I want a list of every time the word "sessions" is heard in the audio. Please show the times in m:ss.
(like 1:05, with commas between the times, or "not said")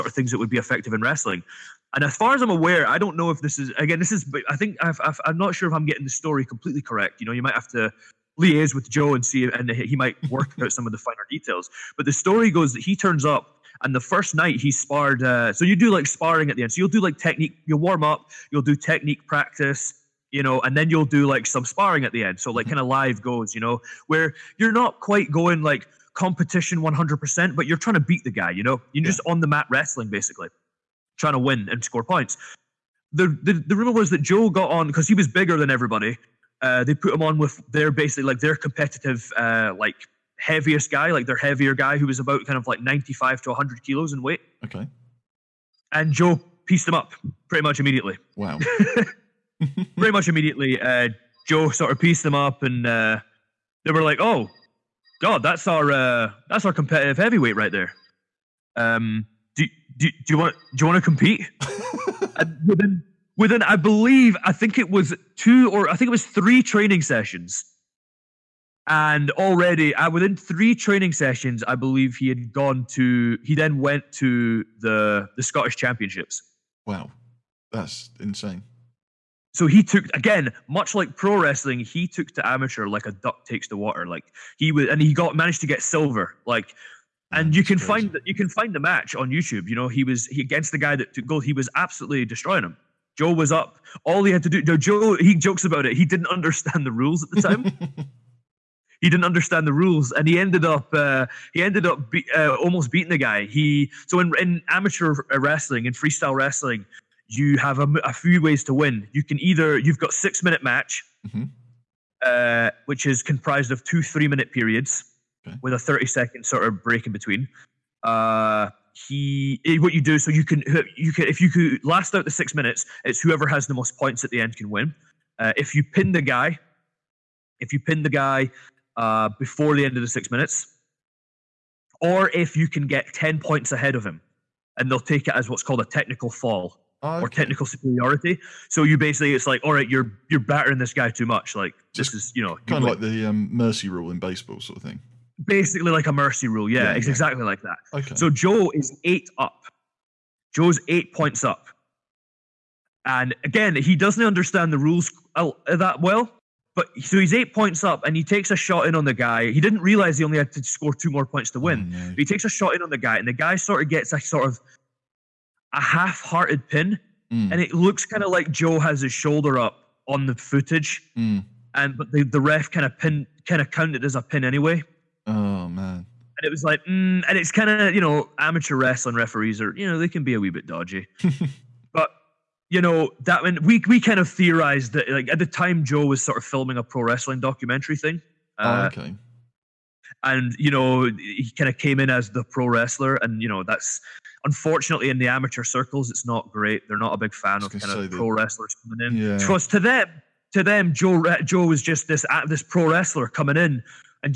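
1:07, 1:11.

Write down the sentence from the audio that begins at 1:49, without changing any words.
You can either you've got six minute match, mm-hmm.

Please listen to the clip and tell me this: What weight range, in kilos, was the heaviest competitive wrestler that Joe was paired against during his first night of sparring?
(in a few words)
95 to 100 kilos.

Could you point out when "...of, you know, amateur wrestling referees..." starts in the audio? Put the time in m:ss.
2:57.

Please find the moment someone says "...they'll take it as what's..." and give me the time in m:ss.
2:14.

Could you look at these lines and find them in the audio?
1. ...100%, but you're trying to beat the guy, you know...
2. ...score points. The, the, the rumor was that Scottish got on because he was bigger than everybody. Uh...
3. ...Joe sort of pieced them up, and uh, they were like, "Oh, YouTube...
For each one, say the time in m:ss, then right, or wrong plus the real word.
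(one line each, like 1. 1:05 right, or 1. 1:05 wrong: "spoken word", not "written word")
1. 0:26 right
2. 0:31 wrong: "Joe", not "Scottish"
3. 0:51 wrong: "God", not "YouTube".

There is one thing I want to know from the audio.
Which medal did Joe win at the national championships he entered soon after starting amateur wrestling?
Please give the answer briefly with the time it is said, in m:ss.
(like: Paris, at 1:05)
Silver, at 1:25.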